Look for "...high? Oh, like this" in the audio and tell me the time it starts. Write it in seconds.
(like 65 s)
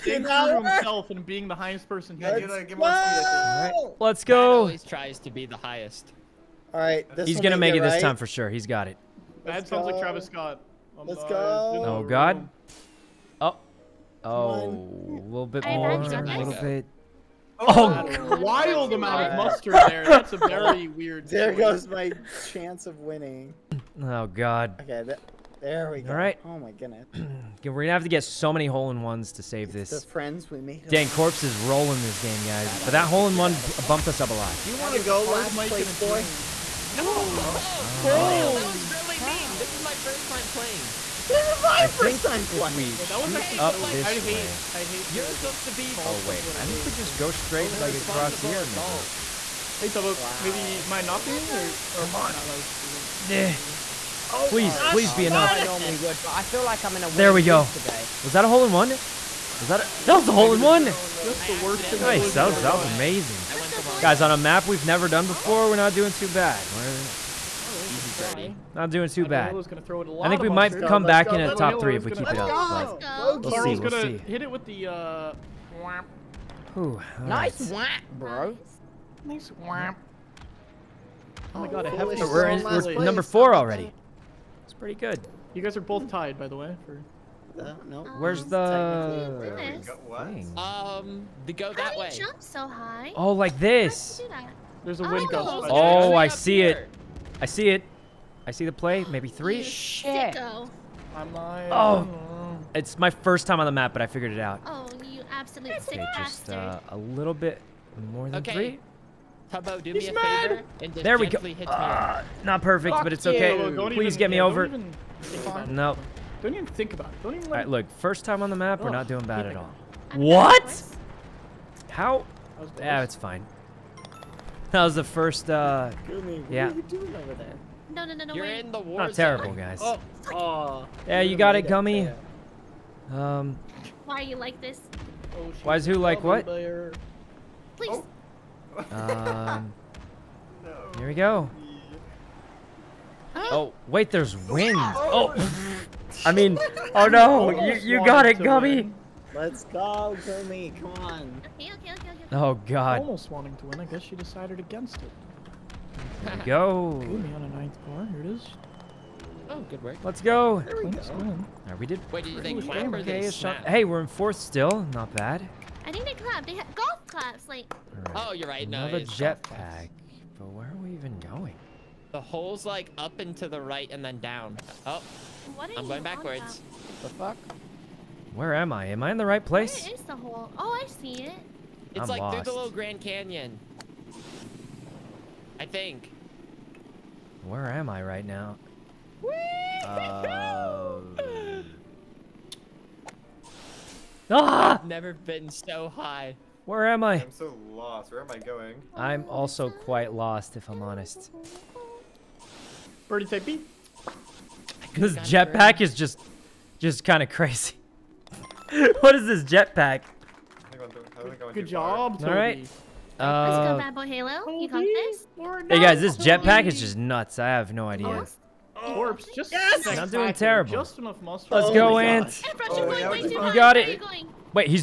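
92 s.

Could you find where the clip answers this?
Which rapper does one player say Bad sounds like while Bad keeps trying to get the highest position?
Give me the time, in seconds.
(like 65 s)
9 s.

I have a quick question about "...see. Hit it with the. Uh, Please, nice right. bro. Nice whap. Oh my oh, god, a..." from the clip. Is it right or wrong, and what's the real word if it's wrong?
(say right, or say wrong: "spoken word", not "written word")
wrong: "Ooh", not "Please".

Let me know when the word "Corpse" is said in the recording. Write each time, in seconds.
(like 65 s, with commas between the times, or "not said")
31 s, 218 s.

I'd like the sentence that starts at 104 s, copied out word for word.
Oh, you absolute sick okay, Just uh, a little bit more than okay.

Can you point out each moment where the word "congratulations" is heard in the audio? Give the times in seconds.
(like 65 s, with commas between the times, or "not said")
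not said.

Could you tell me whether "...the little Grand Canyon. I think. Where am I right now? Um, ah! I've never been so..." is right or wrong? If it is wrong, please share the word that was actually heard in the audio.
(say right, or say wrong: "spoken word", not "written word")
right.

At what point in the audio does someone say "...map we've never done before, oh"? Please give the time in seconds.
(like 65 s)
64 s.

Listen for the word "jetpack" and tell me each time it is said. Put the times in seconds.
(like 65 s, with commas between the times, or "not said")
169 s, 205 s, 209 s, 216 s.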